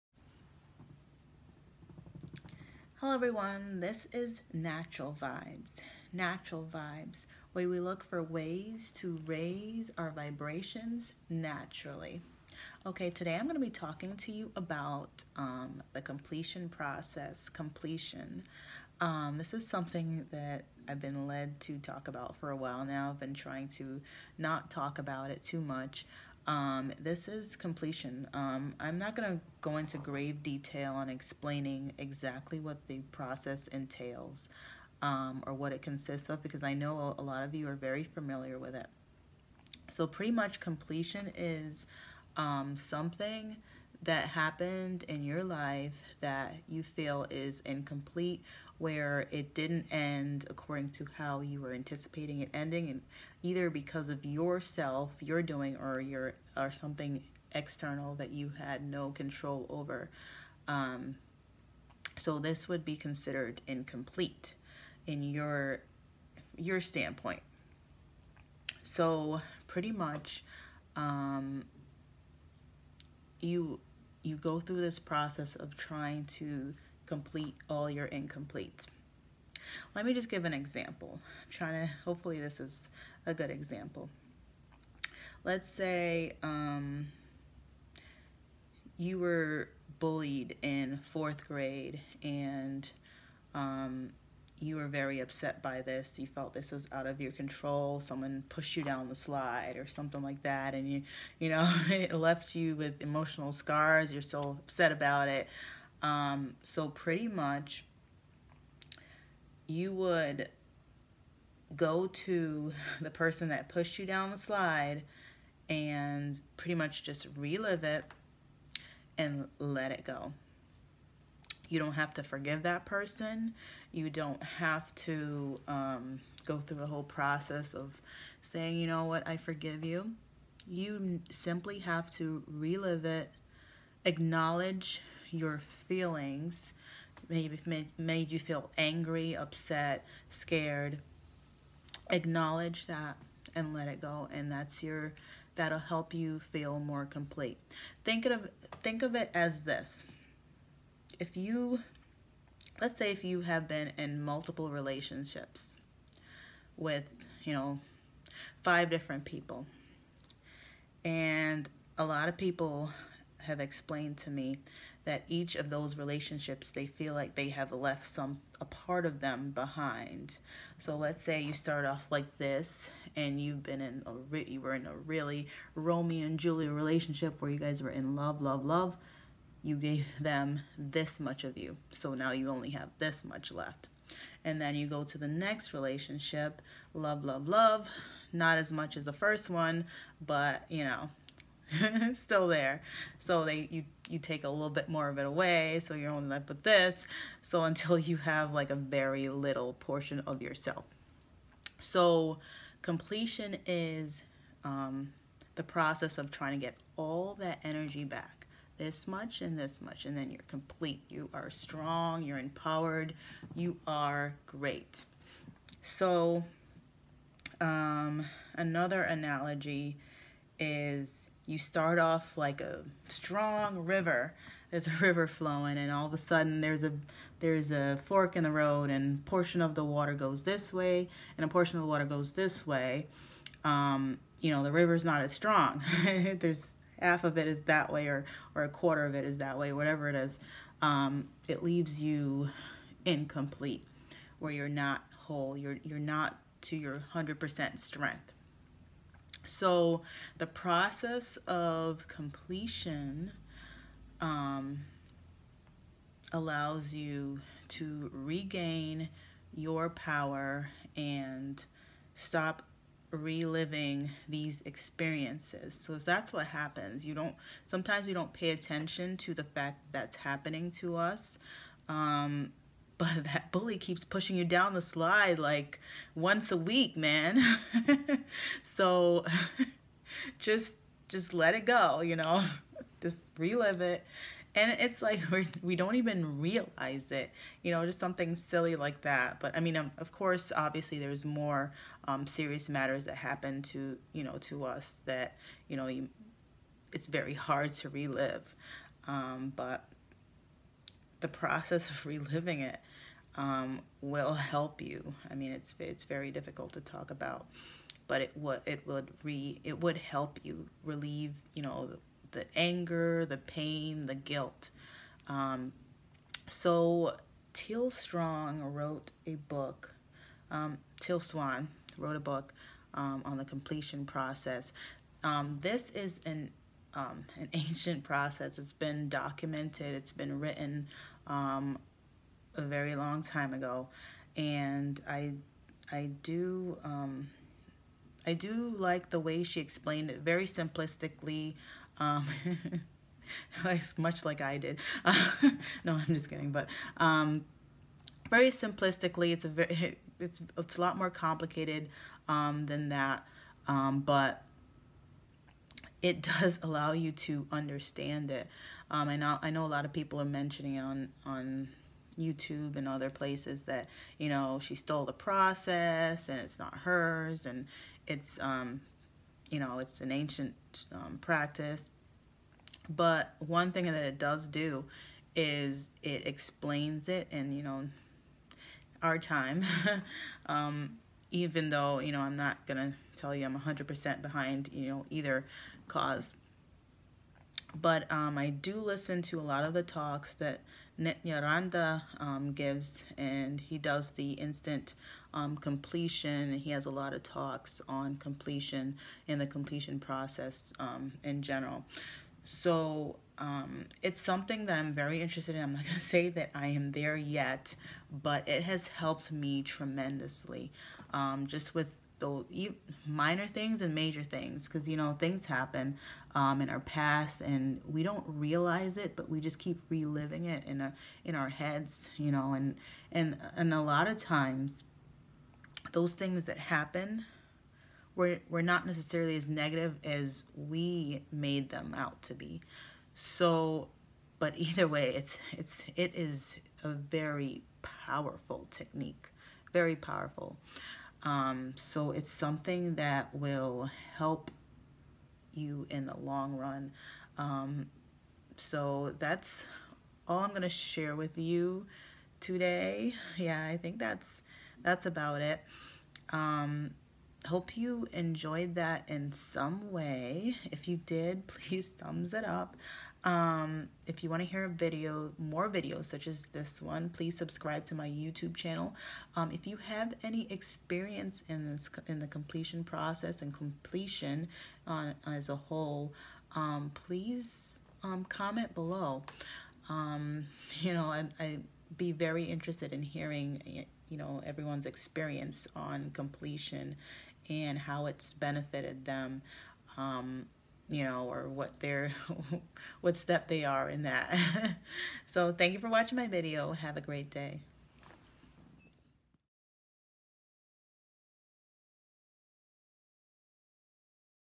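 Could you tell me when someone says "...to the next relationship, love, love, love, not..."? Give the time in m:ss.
3:05.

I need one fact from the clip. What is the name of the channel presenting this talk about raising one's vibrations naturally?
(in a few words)
Natural Vibes.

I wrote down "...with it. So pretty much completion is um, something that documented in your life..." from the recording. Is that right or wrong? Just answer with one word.
wrong.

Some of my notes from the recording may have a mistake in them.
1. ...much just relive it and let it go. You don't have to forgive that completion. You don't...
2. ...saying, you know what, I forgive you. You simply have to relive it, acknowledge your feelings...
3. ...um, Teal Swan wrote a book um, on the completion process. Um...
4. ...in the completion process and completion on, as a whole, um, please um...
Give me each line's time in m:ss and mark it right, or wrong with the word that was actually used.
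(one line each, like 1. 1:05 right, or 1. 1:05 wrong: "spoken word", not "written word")
1. 1:56 wrong: "person", not "completion"
2. 2:08 right
3. 5:20 right
4. 7:52 right.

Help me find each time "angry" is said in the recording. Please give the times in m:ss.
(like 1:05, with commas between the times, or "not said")
2:18.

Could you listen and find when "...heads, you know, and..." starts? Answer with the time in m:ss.
7:01.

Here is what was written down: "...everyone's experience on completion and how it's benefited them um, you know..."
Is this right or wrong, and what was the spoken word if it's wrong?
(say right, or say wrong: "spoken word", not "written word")
right.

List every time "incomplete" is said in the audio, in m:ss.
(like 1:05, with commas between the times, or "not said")
0:47, 1:03, 1:18, 4:03.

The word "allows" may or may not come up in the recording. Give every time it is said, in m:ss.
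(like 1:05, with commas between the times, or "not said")
4:16, 5:56.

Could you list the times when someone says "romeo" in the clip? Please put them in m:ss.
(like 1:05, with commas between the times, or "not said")
2:55.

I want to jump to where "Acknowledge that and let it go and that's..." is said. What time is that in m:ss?
2:22.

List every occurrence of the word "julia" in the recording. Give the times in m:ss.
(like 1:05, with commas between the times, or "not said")
2:56.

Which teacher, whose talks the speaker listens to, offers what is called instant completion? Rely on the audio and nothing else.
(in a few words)
Nithyananda.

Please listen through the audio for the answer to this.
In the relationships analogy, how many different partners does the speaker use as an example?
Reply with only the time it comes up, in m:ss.
2:38.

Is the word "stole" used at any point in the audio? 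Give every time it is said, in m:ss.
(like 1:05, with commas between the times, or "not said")
6:04.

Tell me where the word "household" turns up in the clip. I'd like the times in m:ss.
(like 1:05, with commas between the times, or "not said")
not said.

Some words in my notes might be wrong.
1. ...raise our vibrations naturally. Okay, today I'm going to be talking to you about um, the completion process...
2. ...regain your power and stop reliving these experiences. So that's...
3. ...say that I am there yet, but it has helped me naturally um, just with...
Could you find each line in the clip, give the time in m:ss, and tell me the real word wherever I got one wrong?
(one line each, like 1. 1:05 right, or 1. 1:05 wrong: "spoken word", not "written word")
1. 0:09 right
2. 4:18 right
3. 6:46 wrong: "tremendously", not "naturally".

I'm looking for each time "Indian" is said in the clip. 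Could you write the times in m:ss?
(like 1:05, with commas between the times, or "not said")
not said.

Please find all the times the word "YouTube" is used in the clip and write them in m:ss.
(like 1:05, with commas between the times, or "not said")
6:02, 7:48.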